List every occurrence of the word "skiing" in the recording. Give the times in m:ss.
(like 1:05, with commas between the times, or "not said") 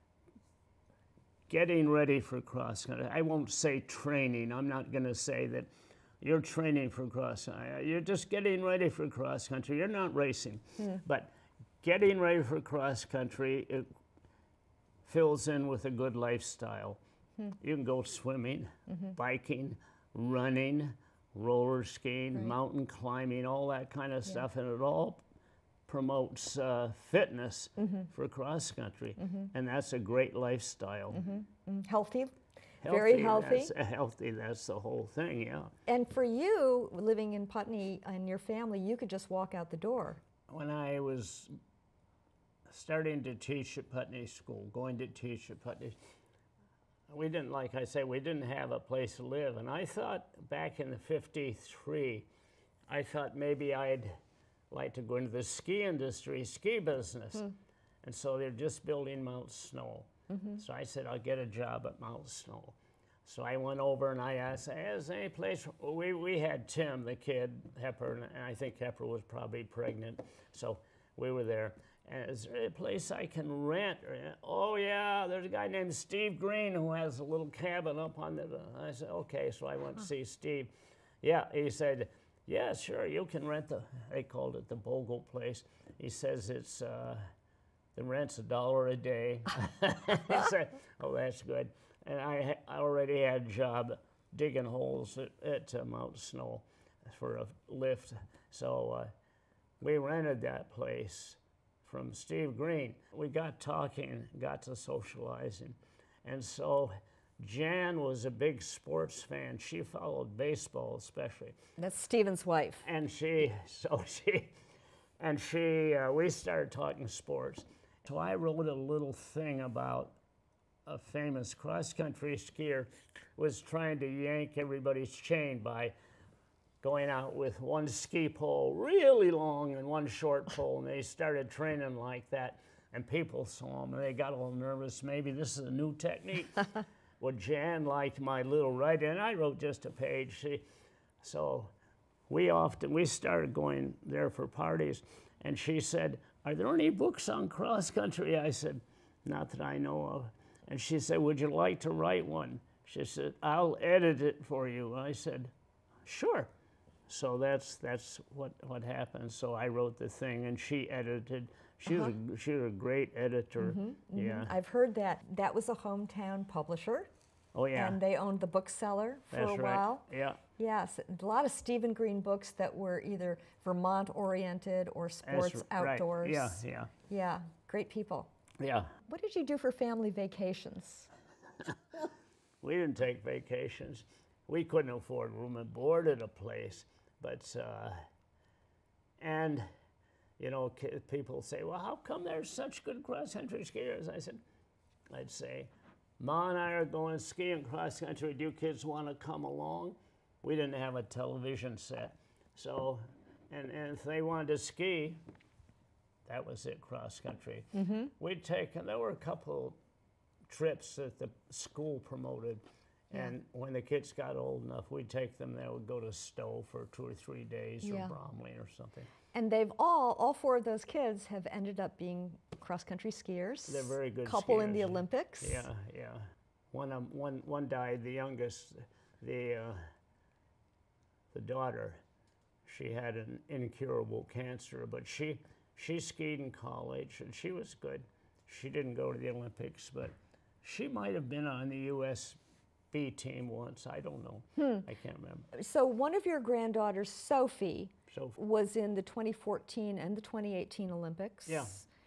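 0:21, 3:17.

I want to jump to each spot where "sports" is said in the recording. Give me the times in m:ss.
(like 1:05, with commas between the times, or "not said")
1:48, 1:57, 2:55.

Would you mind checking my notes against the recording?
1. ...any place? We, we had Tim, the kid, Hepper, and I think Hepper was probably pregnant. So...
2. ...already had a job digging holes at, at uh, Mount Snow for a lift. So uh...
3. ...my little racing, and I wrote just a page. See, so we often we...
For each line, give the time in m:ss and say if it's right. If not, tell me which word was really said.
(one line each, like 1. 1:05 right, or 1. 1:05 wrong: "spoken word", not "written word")
1. 1:05 right
2. 1:32 right
3. 2:18 wrong: "writing", not "racing".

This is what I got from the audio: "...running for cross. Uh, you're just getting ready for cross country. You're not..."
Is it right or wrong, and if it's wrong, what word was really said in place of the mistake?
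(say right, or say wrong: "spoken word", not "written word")
wrong: "training", not "running".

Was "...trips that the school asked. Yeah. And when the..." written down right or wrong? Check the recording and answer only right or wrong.
wrong.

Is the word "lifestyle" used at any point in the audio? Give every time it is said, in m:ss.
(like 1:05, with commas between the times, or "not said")
0:16, 0:30.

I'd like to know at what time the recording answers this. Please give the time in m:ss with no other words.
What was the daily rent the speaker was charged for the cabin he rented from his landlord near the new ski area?
1:28.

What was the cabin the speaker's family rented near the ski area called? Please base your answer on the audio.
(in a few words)
the Bogle place.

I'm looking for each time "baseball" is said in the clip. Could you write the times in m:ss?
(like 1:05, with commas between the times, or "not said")
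1:50.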